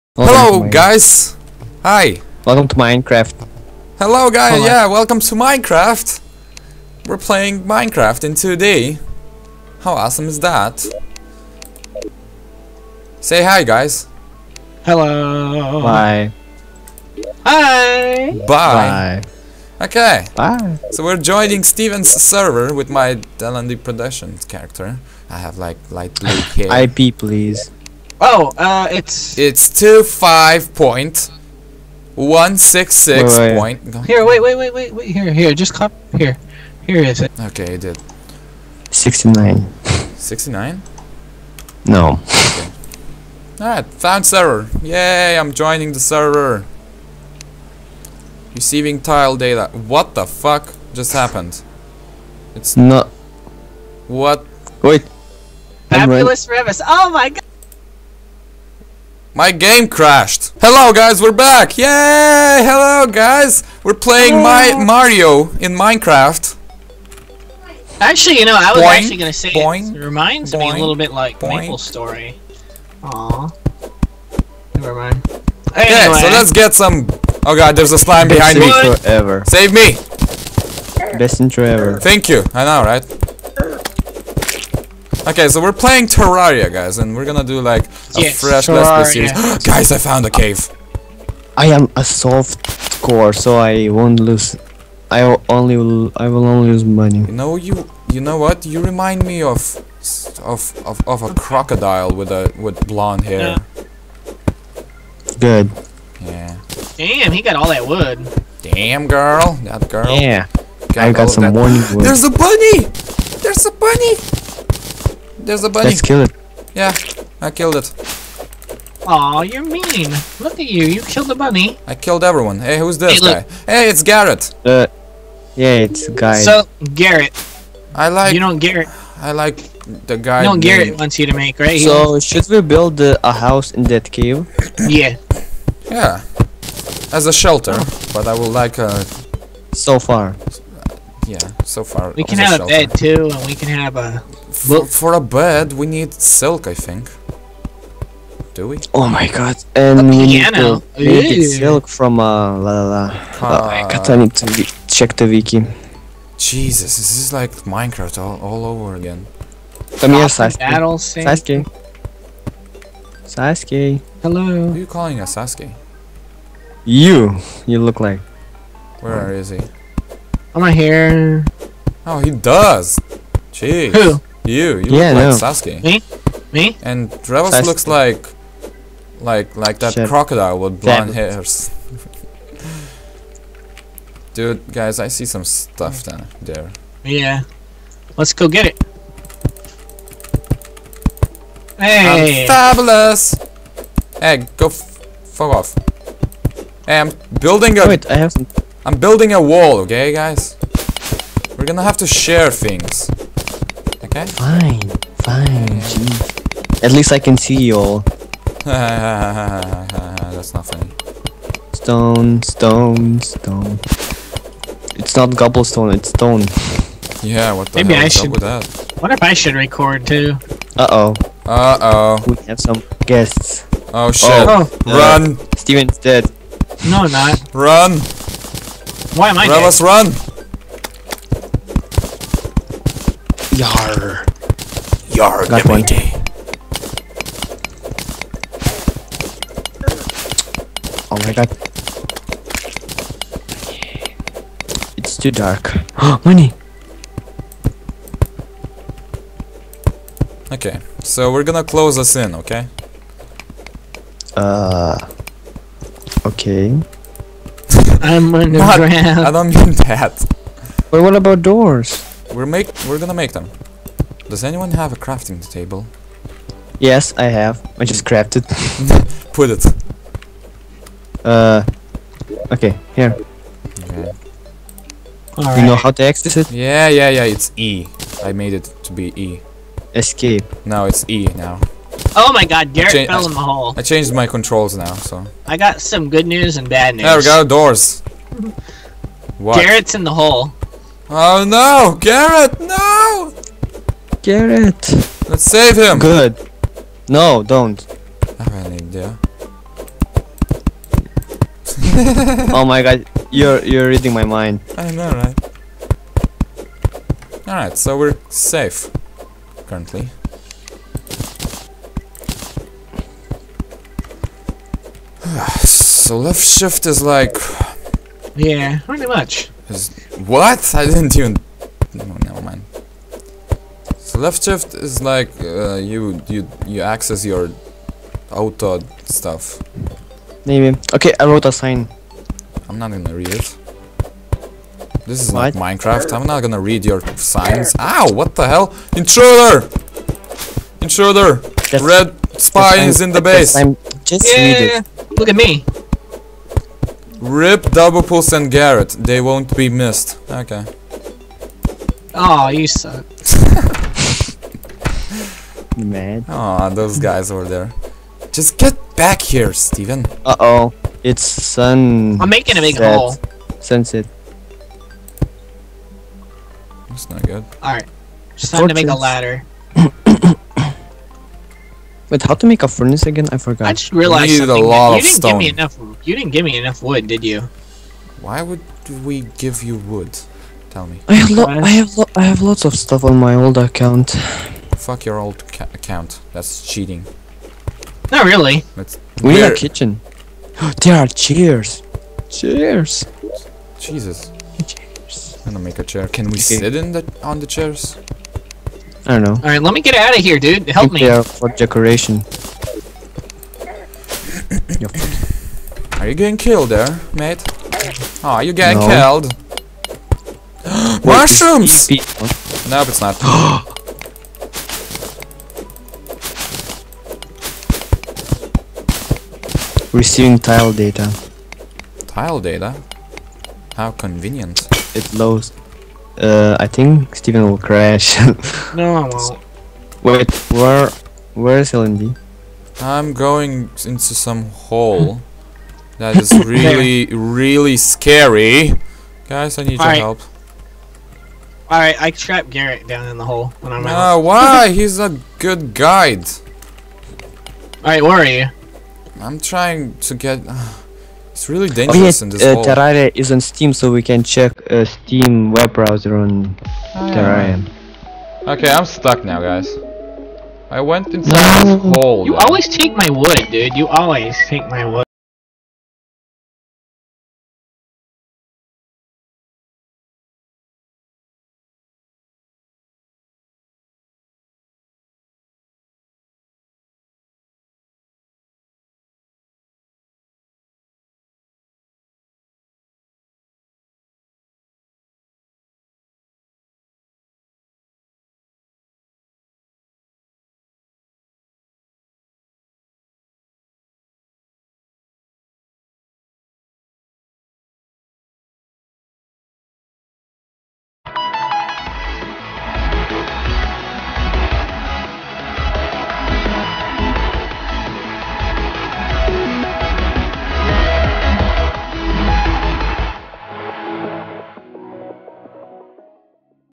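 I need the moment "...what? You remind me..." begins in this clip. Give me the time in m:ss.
1:38.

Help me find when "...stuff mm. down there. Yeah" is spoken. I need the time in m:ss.
3:05.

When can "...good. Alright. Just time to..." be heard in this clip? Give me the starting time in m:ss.
6:07.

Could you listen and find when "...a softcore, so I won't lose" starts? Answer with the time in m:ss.
1:31.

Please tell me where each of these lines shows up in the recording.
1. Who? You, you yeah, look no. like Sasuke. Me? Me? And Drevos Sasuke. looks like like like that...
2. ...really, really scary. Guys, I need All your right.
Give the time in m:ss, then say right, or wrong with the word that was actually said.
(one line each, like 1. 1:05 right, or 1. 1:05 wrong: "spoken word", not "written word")
1. 2:53 right
2. 7:16 right.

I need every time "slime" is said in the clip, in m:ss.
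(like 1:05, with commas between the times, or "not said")
1:17.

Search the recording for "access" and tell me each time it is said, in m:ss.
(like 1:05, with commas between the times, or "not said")
4:36, 5:26.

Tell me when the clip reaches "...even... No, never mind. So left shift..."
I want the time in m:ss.
5:21.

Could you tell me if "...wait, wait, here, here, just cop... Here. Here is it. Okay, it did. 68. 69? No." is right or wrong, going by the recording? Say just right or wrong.
wrong.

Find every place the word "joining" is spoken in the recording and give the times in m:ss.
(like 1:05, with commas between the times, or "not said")
0:21, 0:45.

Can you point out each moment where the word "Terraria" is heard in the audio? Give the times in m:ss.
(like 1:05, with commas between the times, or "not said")
1:26, 7:32.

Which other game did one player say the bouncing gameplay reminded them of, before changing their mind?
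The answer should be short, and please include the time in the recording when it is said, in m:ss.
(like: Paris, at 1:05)
Maple Story, at 1:11.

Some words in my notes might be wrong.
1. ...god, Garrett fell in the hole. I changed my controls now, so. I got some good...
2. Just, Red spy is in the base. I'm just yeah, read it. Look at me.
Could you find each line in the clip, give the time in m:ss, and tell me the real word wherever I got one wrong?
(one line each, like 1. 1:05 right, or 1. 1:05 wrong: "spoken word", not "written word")
1. 4:42 right
2. 5:41 right.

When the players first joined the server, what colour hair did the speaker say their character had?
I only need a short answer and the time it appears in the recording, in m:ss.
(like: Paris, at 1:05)
Light blue, at 0:25.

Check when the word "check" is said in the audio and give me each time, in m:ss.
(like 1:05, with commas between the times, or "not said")
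2:34, 7:34.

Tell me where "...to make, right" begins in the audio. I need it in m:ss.
2:11.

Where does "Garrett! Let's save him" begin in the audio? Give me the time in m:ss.
4:54.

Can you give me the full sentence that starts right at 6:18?
Why would we give you wood?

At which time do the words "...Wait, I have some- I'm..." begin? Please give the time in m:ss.
3:17.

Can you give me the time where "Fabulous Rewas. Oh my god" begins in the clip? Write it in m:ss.
0:55.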